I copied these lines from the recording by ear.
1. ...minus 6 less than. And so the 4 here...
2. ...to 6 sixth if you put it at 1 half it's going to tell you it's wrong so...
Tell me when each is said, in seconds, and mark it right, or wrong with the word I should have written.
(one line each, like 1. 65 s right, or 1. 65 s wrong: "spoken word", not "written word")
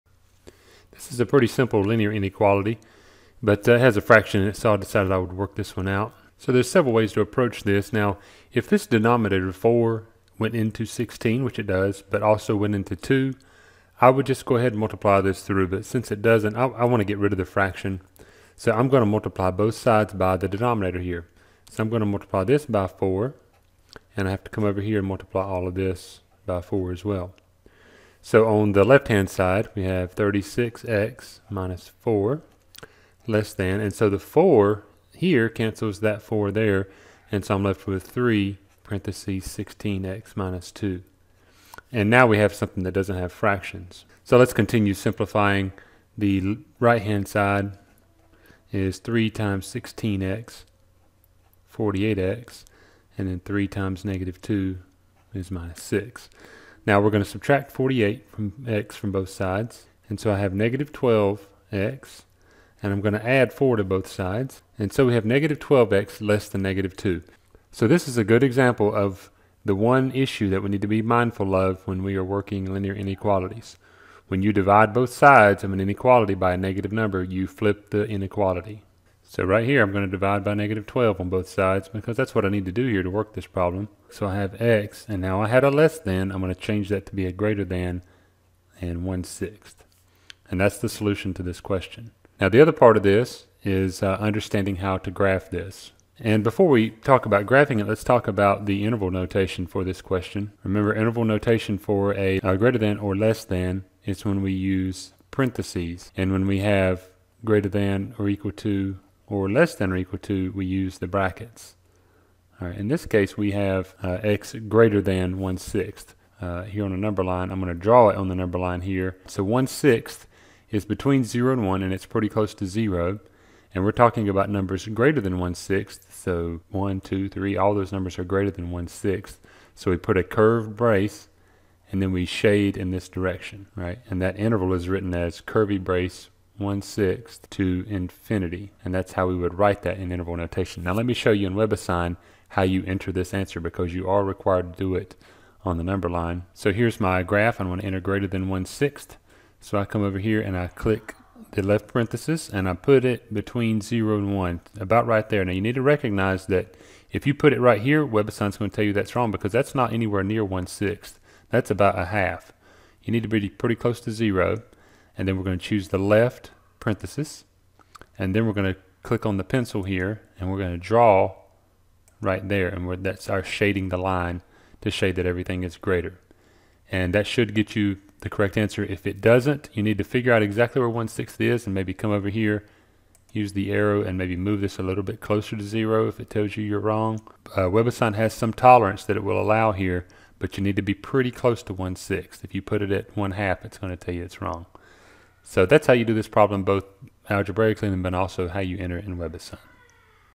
1. 31 s wrong: "4", not "6"
2. 191 s wrong: "1", not "6".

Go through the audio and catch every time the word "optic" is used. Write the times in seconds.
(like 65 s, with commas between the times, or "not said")
not said.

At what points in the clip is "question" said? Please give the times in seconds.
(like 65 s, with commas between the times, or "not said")
91 s, 100 s.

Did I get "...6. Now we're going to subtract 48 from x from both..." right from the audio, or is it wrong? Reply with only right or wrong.
right.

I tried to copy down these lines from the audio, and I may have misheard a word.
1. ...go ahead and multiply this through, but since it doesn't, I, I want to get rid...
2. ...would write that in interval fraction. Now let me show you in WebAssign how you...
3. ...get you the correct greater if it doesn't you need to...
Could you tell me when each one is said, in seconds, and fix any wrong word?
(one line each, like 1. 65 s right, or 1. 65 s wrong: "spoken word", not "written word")
1. 14 s right
2. 139 s wrong: "notation", not "fraction"
3. 177 s wrong: "answer", not "greater".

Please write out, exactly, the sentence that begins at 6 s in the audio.
So there's several ways to approach this.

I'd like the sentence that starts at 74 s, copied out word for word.
When you divide both sides of an inequality by a negative number, you flip the inequality.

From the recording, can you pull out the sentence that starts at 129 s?
So we put a curved brace, and then we shade in this direction, right?